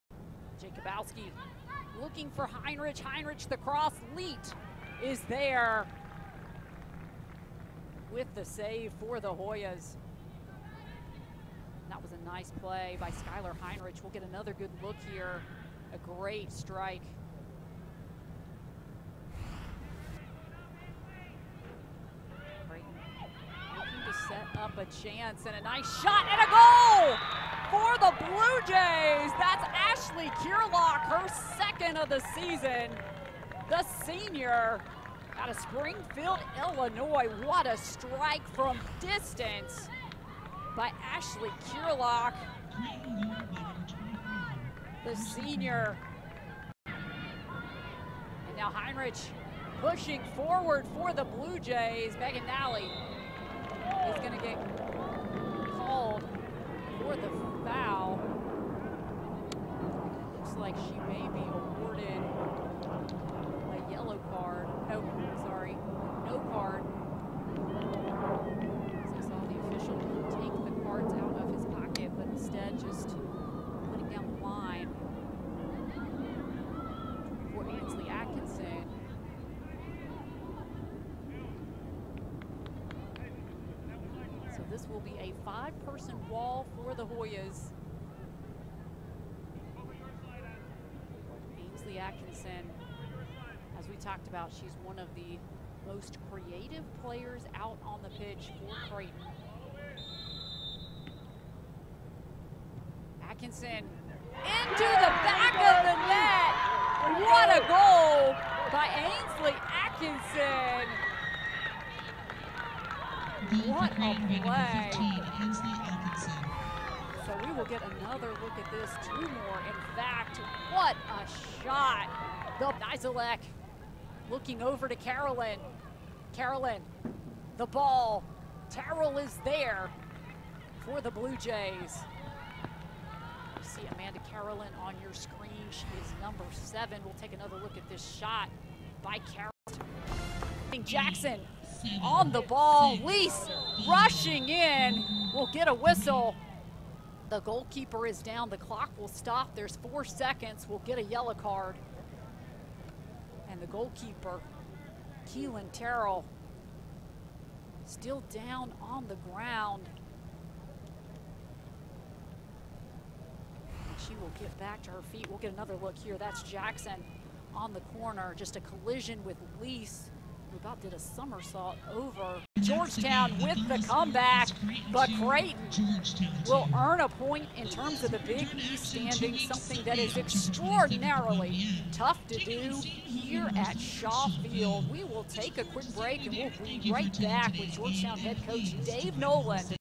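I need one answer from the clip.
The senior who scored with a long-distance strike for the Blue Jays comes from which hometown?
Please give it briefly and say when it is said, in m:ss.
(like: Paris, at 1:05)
Springfield, Illinois, at 0:35.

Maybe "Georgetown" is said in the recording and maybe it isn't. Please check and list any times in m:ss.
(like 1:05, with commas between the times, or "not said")
2:52, 3:07.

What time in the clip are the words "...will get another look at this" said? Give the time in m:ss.
1:57.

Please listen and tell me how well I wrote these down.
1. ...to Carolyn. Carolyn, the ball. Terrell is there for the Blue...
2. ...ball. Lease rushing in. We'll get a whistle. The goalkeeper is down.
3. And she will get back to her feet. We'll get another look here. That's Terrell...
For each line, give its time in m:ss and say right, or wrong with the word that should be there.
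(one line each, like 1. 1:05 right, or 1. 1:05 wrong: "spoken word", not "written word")
1. 2:04 right
2. 2:22 right
3. 2:43 wrong: "Jackson", not "Terrell".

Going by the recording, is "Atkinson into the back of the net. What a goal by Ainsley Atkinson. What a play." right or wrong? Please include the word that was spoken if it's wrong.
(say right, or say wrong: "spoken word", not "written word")
right.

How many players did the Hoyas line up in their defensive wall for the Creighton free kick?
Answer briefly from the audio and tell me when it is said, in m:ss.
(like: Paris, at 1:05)
5, at 1:25.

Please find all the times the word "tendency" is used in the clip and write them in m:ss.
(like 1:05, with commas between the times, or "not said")
not said.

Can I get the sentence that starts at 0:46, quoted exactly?
And now Heinrich pushing forward for the Blue Jays.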